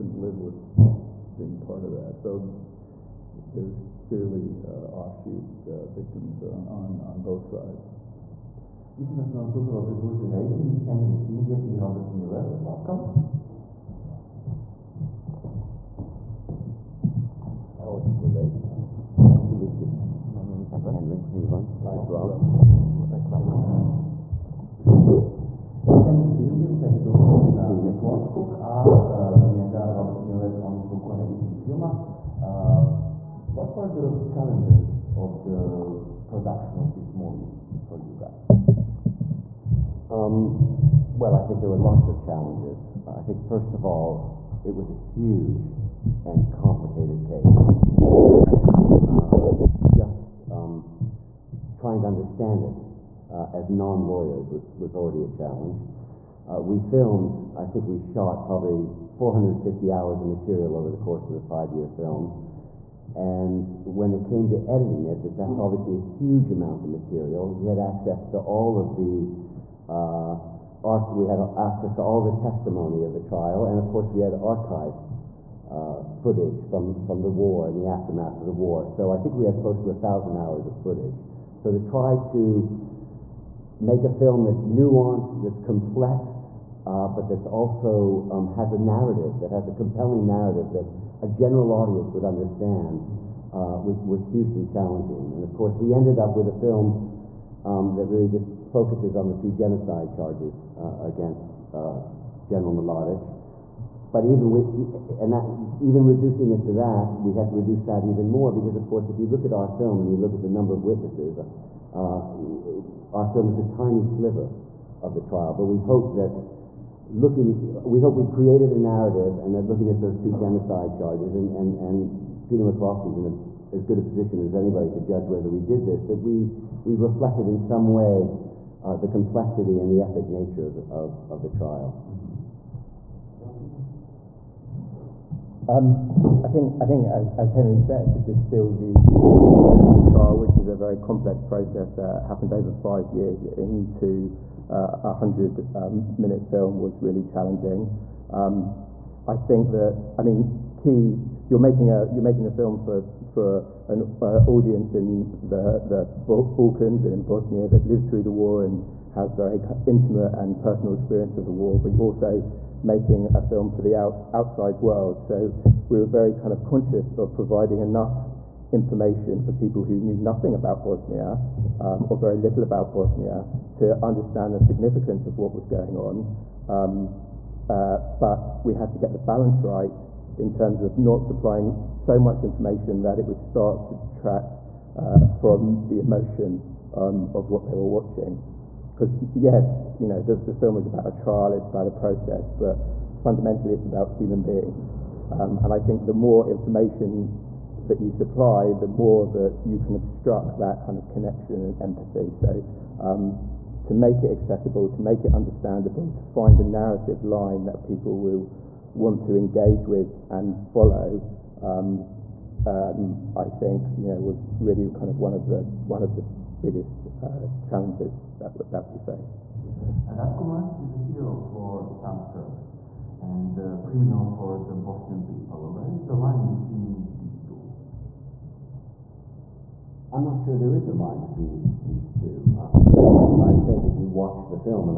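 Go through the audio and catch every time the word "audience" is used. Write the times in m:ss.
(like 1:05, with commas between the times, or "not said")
1:31, 2:34.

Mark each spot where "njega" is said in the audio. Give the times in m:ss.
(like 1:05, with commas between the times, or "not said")
0:29.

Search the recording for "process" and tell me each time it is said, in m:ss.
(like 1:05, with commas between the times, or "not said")
2:21, 3:11.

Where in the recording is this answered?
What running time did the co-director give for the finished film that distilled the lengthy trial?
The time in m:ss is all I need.
2:25.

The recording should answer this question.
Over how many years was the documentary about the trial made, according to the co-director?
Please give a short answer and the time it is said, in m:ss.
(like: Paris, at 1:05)
5, at 1:01.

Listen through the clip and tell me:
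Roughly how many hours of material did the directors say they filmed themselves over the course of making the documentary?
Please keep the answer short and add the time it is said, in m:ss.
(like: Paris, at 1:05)
450, at 0:59.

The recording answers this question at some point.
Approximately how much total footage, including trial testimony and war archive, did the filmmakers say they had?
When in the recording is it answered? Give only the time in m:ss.
1:19.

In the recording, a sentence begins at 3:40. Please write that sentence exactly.
Ratko Mladic is a hero for some Serbs and a criminal for the Bosnian people.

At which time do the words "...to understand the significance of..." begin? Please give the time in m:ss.
2:53.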